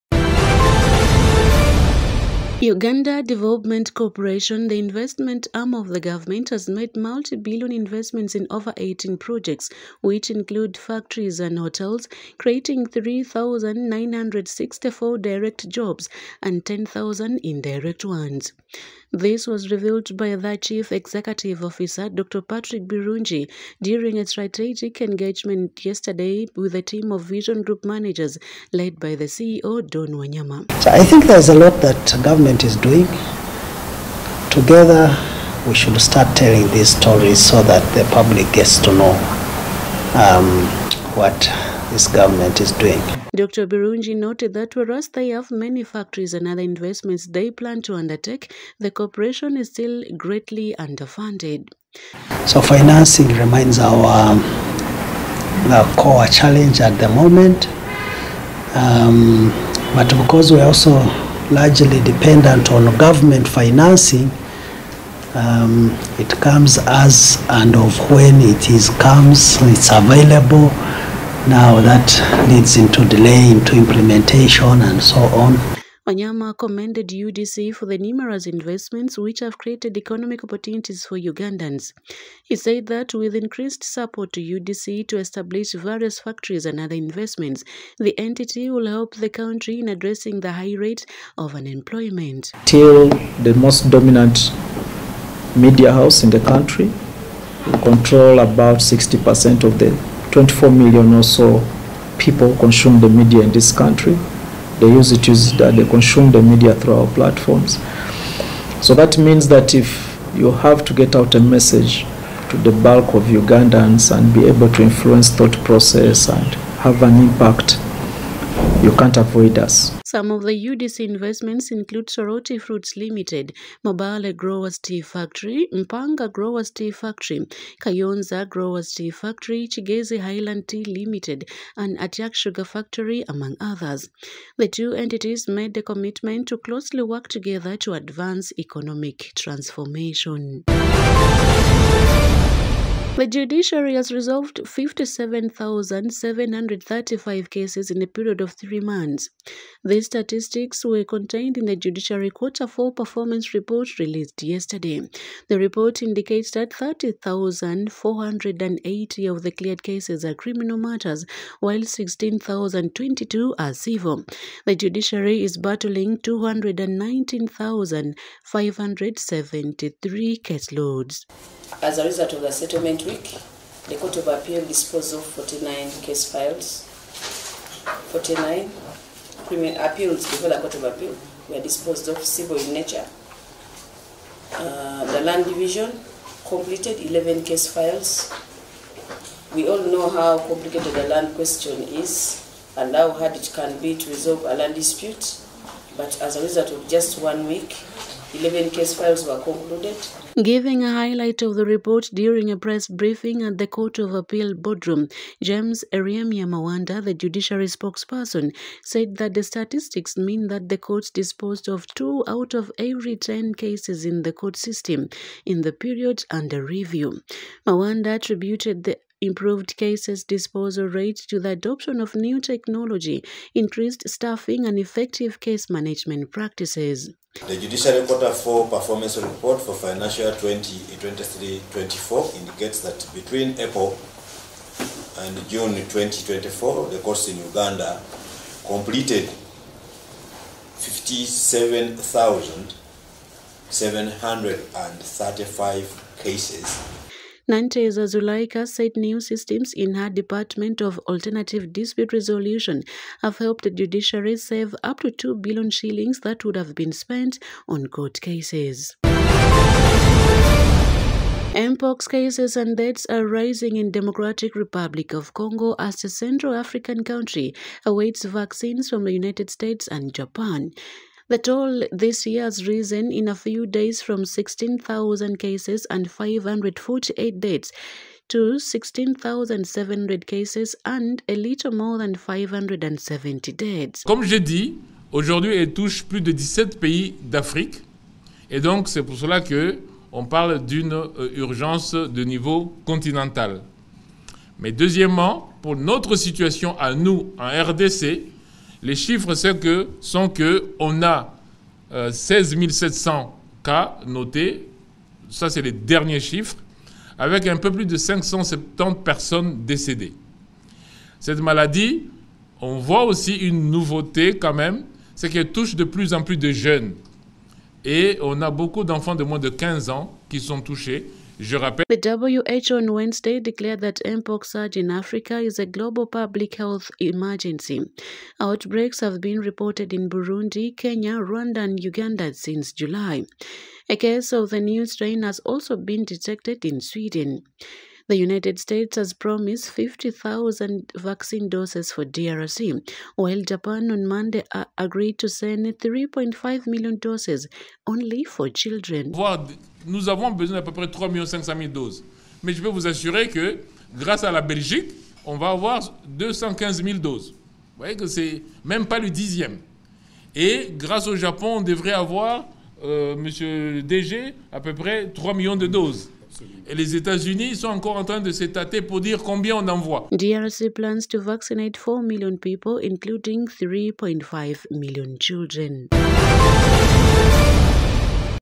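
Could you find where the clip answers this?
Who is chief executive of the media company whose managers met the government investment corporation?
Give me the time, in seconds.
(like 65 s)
29 s.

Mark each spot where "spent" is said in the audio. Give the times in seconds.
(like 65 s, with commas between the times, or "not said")
256 s.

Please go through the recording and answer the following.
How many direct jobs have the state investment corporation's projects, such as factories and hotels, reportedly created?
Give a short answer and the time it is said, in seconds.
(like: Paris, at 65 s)
3,964, at 12 s.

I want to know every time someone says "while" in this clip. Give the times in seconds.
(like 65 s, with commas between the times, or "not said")
161 s, 343 s.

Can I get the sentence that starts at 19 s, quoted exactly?
This was revealed by the Chief Executive Officer, Dr.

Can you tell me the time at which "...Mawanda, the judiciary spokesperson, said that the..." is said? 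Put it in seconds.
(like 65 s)
206 s.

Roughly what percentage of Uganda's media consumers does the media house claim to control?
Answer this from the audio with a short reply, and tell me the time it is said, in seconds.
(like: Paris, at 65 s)
60%, at 98 s.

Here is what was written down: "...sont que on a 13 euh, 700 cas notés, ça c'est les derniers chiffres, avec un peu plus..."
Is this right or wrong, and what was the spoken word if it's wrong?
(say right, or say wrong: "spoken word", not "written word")
wrong: "16", not "13".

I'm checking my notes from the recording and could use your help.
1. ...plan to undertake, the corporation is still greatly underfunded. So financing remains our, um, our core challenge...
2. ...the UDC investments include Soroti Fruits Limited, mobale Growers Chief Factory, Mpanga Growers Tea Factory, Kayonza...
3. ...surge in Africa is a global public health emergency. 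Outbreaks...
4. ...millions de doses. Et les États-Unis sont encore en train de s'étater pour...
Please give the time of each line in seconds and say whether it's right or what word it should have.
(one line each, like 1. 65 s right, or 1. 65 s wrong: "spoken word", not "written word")
1. 47 s right
2. 120 s wrong: "Tea", not "Chief"
3. 324 s right
4. 365 s right.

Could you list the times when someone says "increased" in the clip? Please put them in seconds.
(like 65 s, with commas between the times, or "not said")
83 s, 223 s.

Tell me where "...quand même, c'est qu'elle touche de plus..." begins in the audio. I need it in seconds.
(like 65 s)
314 s.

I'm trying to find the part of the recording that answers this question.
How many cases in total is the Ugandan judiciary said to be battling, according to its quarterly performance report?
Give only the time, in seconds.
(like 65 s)
166 s.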